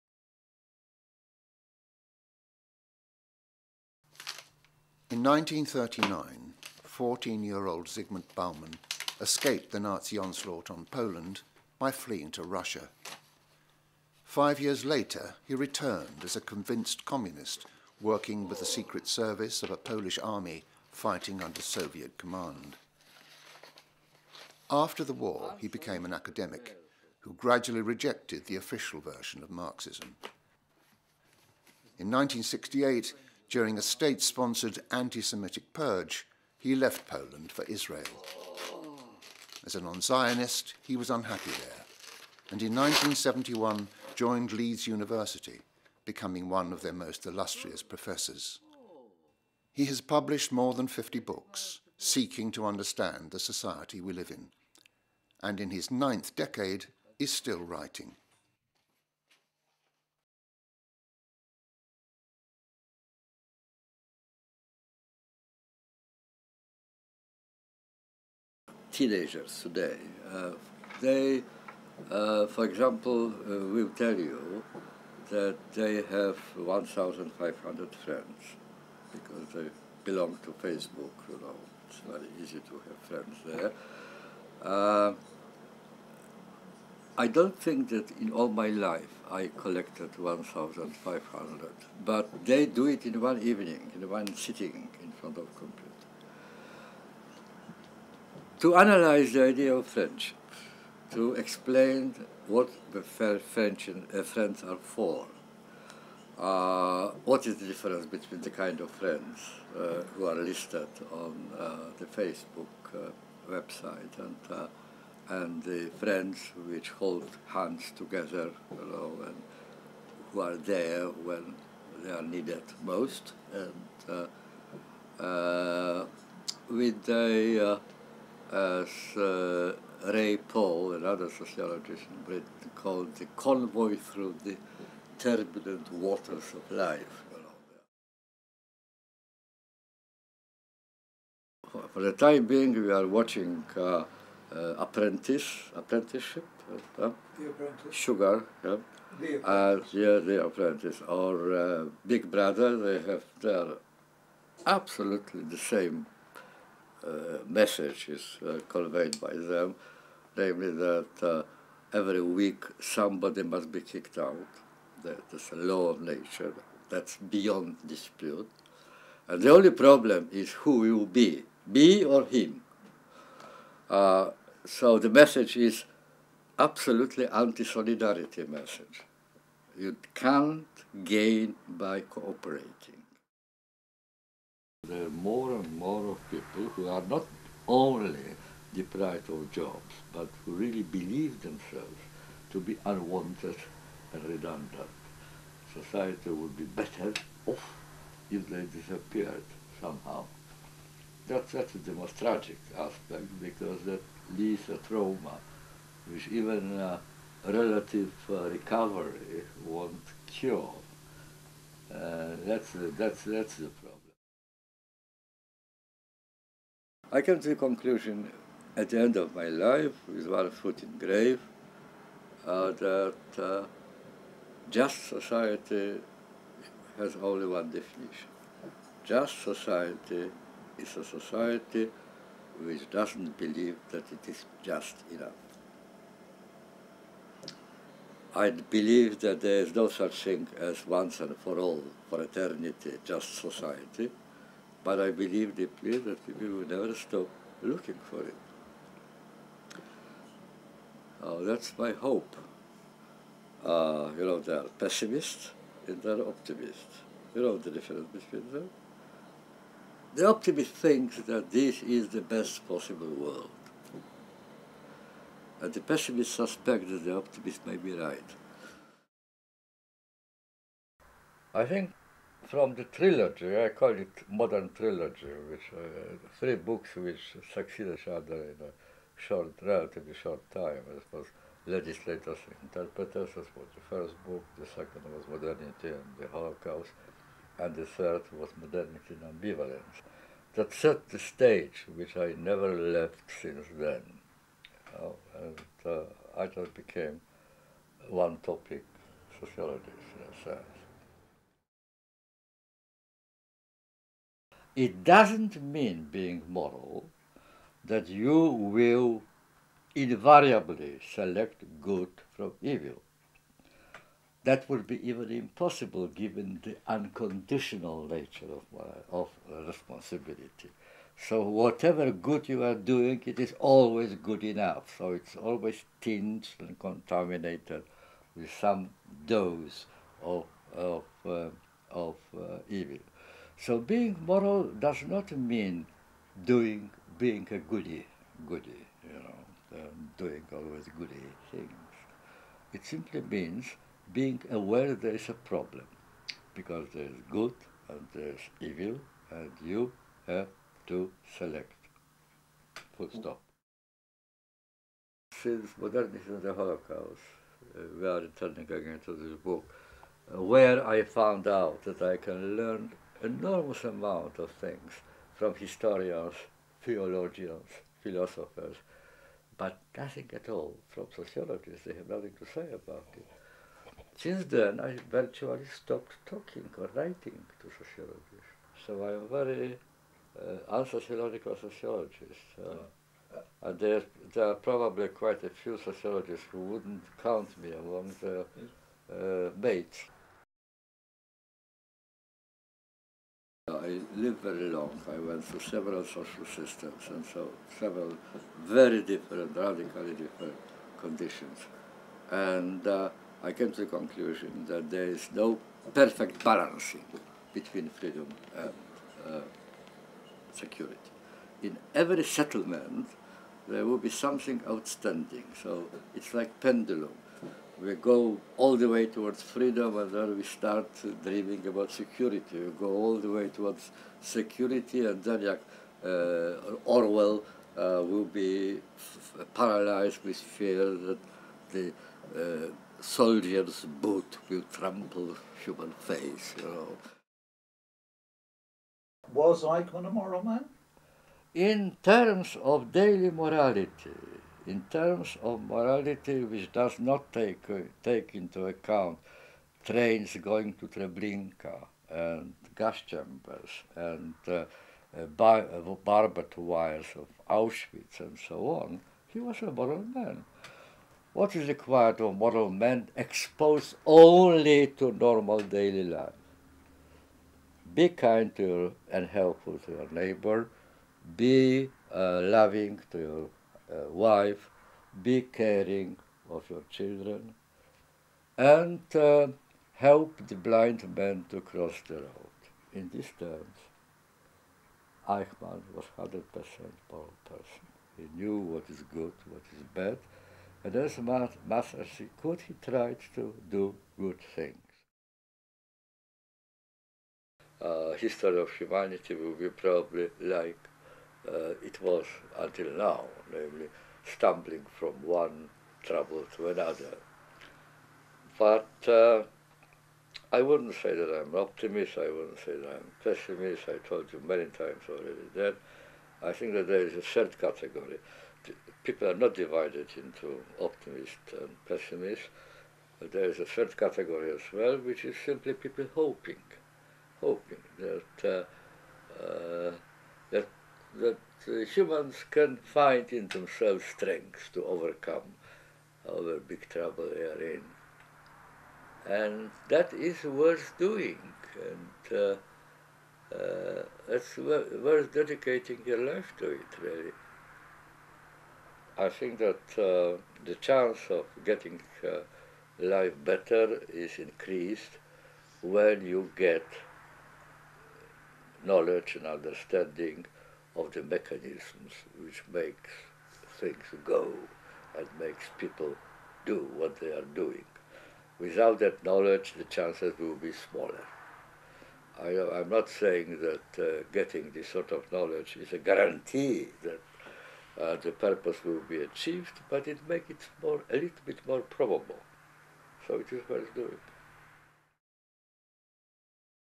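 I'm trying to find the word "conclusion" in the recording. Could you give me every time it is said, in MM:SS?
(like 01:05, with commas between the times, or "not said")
03:37, 06:43.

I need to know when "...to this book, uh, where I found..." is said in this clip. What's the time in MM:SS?
05:59.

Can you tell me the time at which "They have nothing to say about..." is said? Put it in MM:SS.
06:11.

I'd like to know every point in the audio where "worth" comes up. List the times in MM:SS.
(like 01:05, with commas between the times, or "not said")
09:00, 09:04, 09:43.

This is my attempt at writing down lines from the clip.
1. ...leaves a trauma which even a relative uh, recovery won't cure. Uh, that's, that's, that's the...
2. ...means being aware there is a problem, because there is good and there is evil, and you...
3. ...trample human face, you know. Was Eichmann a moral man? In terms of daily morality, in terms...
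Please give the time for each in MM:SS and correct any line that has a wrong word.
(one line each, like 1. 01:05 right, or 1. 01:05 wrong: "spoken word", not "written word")
1. 03:24 right
2. 05:43 right
3. 07:14 right.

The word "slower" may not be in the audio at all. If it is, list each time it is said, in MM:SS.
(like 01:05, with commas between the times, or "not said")
not said.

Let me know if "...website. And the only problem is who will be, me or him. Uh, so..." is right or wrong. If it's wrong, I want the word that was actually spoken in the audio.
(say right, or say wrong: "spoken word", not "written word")
wrong: "dispute", not "website".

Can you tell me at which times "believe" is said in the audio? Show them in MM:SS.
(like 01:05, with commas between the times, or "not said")
03:10, 03:53, 03:58, 04:05.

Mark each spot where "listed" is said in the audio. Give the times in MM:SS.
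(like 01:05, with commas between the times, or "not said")
01:50.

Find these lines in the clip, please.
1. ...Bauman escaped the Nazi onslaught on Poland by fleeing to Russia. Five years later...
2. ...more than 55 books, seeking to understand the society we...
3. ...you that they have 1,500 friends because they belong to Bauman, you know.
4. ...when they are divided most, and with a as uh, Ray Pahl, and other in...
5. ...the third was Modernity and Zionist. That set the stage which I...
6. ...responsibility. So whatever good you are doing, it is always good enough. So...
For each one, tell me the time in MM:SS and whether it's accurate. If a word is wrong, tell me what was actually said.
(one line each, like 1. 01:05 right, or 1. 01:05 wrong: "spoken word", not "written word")
1. 00:08 right
2. 00:50 wrong: "50", not "55"
3. 01:14 wrong: "Facebook", not "Bauman"
4. 02:01 wrong: "needed", not "divided"
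5. 04:47 wrong: "Ambivalence", not "Zionist"
6. 05:19 right.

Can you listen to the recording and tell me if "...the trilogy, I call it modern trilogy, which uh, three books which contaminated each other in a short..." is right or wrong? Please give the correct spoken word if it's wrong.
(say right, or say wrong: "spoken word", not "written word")
wrong: "succeed", not "contaminated".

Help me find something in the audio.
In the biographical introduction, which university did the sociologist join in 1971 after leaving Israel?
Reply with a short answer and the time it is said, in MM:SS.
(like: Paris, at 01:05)
Leeds University, at 00:44.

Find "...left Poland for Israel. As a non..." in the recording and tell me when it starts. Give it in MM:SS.
00:36.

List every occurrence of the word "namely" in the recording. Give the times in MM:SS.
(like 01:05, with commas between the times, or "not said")
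02:40, 08:23.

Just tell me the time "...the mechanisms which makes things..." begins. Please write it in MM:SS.
09:21.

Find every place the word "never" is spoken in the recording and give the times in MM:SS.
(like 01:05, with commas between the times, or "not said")
04:06, 04:52.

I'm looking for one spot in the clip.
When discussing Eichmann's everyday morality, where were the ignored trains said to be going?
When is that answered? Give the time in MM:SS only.
07:30.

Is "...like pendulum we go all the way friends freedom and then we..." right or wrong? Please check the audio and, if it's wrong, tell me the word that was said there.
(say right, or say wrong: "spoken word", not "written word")
wrong: "towards", not "friends".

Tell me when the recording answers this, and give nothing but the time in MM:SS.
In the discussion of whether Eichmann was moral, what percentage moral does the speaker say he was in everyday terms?
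08:06.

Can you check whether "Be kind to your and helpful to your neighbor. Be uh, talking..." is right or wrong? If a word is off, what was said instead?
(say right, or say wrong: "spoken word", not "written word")
wrong: "loving", not "talking".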